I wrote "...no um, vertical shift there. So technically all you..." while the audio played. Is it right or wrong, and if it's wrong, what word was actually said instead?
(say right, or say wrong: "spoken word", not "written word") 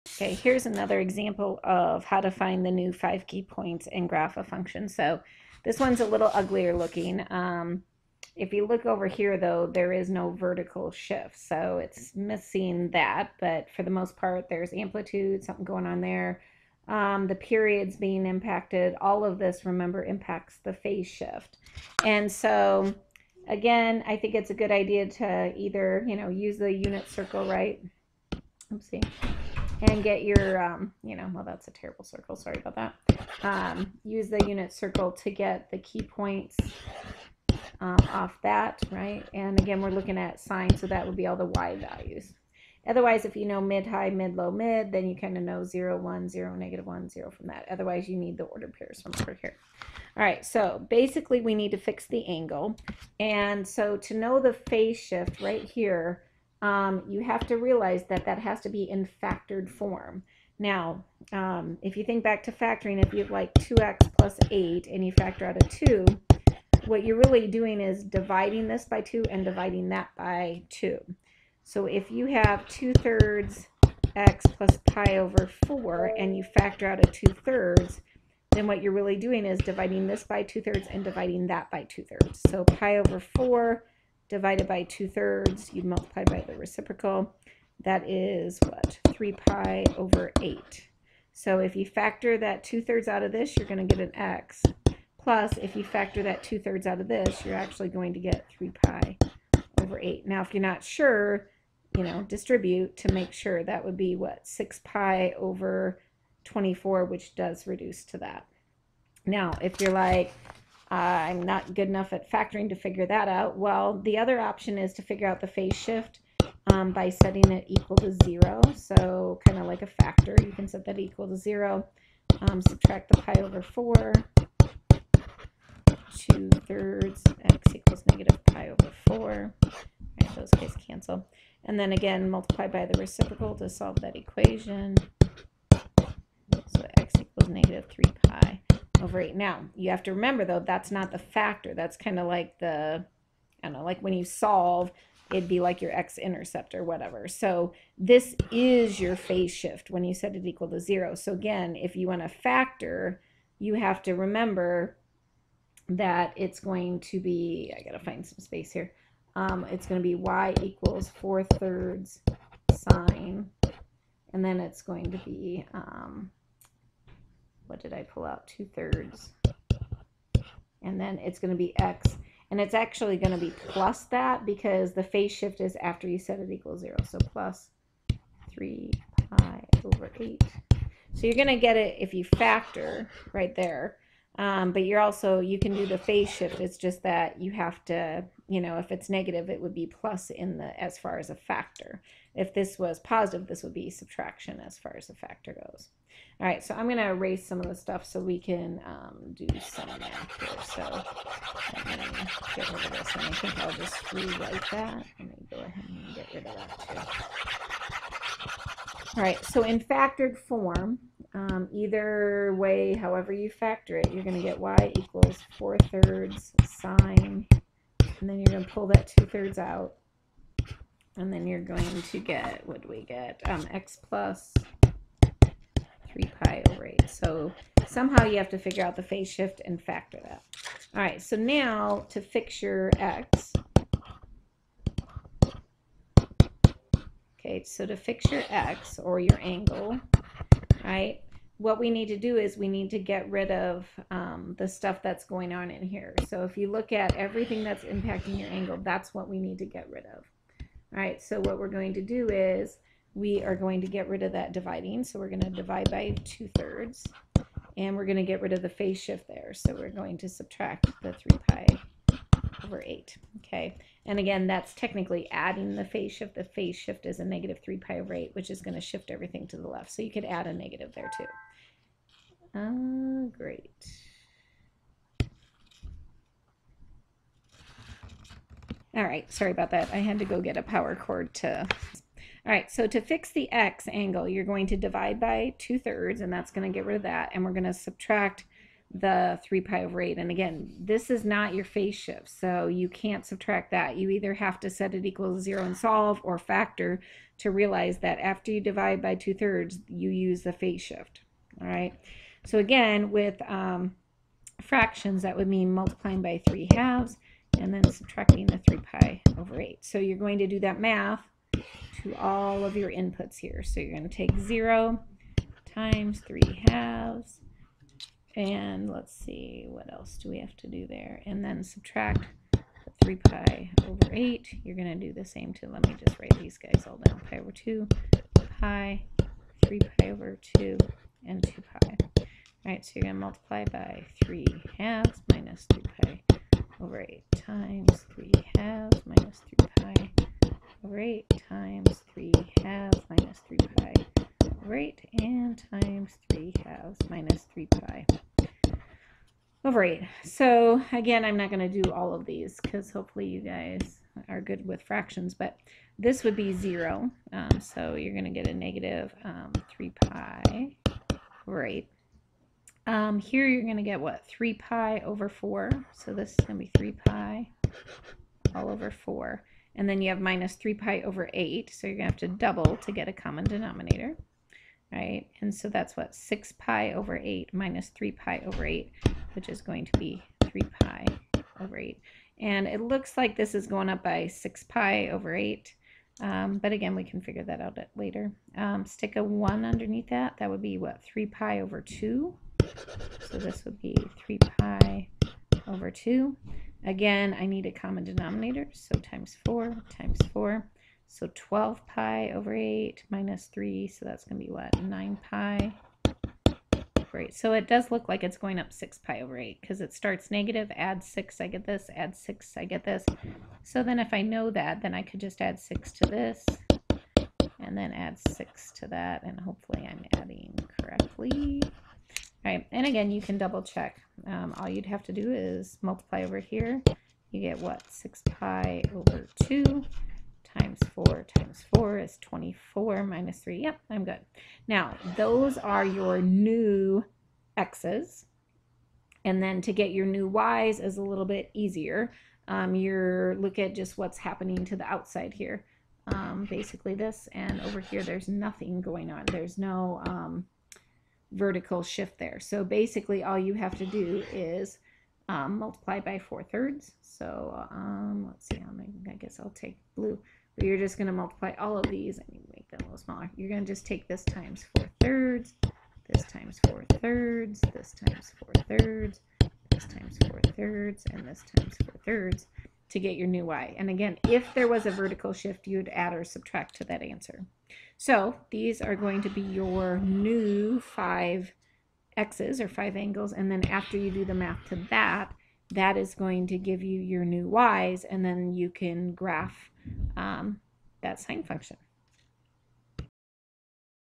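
wrong: "basically", not "technically".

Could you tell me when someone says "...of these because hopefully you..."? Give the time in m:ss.
5:52.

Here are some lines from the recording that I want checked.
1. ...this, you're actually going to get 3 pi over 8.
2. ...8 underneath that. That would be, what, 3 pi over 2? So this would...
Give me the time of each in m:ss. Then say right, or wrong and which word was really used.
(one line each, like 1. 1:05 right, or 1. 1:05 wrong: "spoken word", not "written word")
1. 1:37 right
2. 6:29 wrong: "1", not "8".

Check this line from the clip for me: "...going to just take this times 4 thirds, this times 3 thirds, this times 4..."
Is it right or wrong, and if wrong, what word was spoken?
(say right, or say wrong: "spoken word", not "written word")
wrong: "4", not "3".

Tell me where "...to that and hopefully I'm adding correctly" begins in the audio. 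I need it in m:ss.
6:58.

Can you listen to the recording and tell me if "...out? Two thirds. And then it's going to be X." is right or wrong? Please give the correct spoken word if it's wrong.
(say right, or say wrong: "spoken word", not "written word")
right.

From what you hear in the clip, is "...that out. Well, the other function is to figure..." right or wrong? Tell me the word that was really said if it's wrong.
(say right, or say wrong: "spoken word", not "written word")
wrong: "option", not "function".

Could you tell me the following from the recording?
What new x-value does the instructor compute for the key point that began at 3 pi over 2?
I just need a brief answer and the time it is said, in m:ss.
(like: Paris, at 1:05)
9π/8, at 6:44.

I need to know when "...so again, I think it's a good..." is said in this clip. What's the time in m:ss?
0:22.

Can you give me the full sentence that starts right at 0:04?
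So this one's a little uglier looking.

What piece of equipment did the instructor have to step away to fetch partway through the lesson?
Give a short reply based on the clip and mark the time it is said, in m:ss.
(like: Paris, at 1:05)
Power cord, at 4:40.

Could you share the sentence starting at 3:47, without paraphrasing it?
So somehow you have to figure out the phase shift and factor that.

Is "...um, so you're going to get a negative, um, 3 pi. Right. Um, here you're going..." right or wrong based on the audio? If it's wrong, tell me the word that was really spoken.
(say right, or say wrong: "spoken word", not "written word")
right.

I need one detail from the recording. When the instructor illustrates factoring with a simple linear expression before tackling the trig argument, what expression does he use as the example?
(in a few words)
2x + 8.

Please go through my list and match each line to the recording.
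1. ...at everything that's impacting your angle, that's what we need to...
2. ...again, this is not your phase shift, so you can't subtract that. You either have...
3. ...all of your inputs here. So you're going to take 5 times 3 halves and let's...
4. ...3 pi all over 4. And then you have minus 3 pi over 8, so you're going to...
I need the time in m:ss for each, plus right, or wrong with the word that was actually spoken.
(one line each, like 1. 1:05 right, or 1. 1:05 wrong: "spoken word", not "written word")
1. 4:06 right
2. 4:50 right
3. 5:12 wrong: "0", not "5"
4. 6:06 right.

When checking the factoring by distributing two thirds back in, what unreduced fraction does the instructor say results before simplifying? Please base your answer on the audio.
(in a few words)
6π/24.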